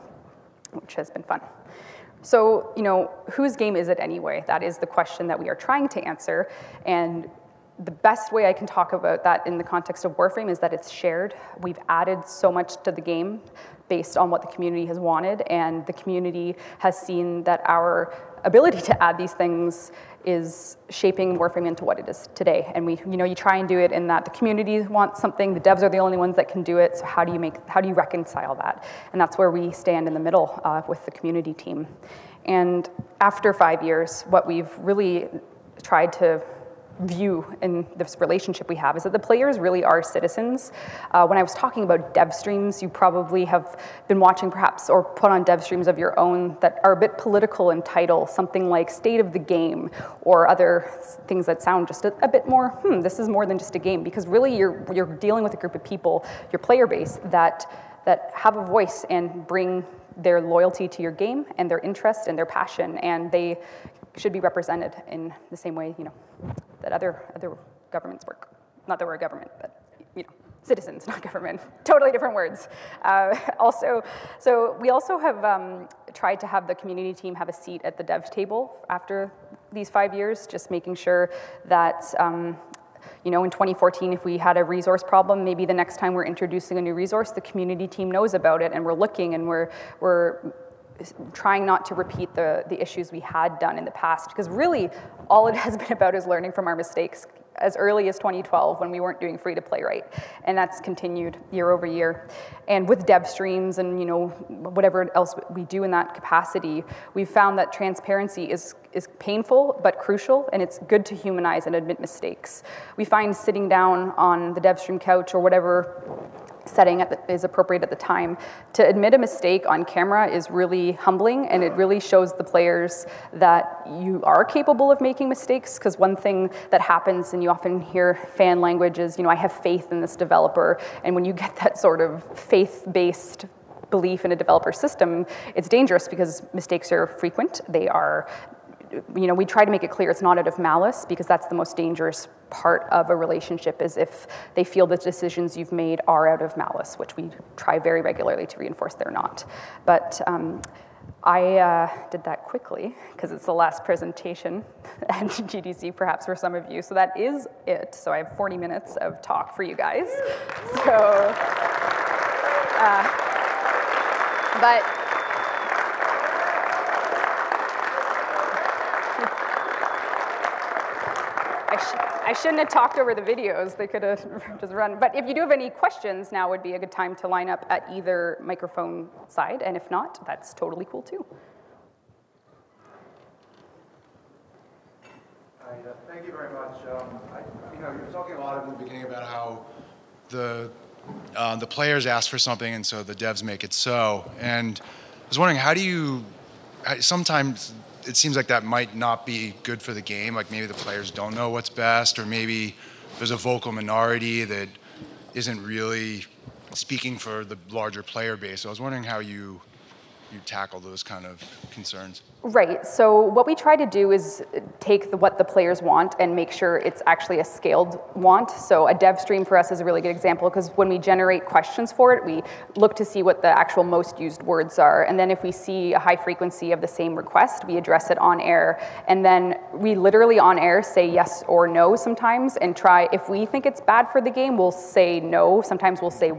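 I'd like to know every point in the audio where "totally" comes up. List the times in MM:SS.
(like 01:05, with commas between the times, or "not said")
01:11, 03:00.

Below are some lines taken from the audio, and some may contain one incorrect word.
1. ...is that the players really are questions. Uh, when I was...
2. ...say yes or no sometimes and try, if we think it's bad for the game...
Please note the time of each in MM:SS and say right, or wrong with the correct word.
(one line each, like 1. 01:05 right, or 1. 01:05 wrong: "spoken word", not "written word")
1. 00:38 wrong: "citizens", not "questions"
2. 03:50 right.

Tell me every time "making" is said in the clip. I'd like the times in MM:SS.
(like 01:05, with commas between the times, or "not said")
01:20, 02:05.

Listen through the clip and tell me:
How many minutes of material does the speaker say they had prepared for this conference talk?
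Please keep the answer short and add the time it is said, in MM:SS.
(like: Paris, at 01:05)
40, at 02:38.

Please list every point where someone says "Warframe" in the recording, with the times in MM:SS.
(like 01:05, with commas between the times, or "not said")
00:10, 00:21.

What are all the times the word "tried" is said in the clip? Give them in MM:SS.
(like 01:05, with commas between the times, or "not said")
00:35, 01:16.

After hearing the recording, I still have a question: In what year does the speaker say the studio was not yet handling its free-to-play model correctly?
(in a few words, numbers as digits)
2012.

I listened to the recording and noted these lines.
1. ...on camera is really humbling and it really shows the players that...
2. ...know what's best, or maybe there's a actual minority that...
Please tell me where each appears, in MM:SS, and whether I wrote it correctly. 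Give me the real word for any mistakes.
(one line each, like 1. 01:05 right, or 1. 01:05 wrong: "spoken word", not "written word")
1. 01:59 right
2. 03:21 wrong: "vocal", not "actual".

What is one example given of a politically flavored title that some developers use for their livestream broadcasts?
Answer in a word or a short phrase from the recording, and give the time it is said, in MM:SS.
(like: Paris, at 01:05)
State of the Game, at 00:48.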